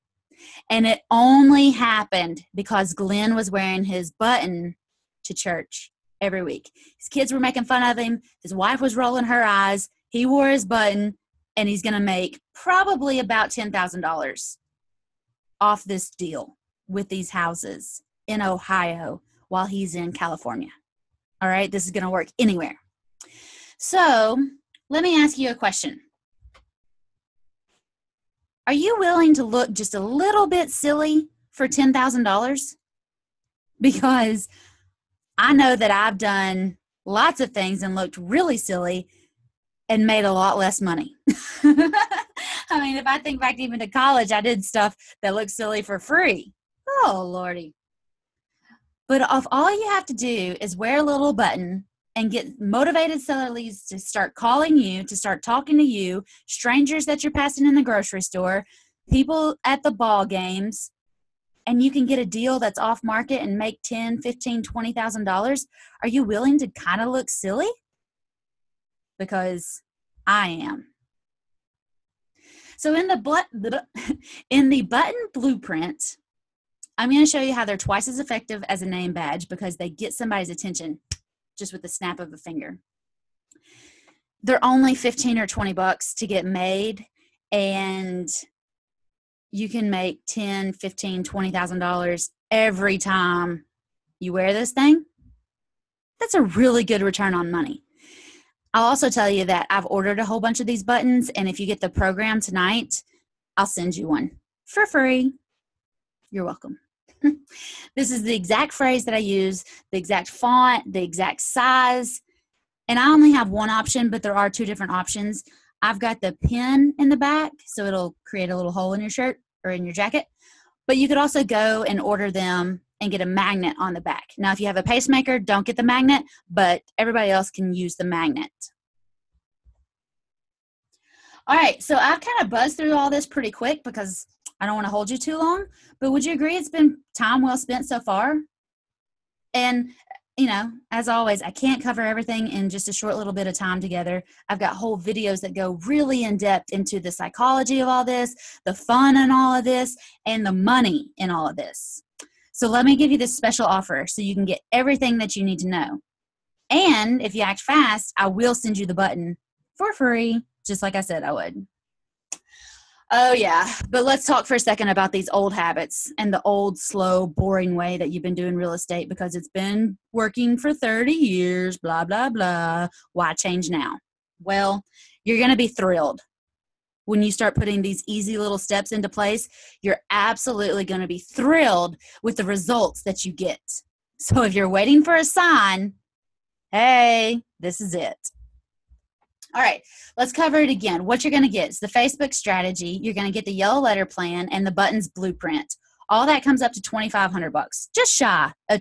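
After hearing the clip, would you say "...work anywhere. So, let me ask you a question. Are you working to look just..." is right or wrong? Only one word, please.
wrong.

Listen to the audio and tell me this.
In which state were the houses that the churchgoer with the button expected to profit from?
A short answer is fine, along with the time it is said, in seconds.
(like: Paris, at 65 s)
Ohio, at 18 s.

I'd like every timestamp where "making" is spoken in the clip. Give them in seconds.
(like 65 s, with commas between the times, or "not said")
7 s.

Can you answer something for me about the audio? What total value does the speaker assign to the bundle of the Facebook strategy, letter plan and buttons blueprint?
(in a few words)
$2,500.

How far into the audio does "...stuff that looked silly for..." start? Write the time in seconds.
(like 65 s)
44 s.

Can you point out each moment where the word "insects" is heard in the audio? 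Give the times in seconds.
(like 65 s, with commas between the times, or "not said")
not said.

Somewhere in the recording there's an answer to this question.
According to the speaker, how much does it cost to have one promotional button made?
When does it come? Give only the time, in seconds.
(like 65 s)
84 s.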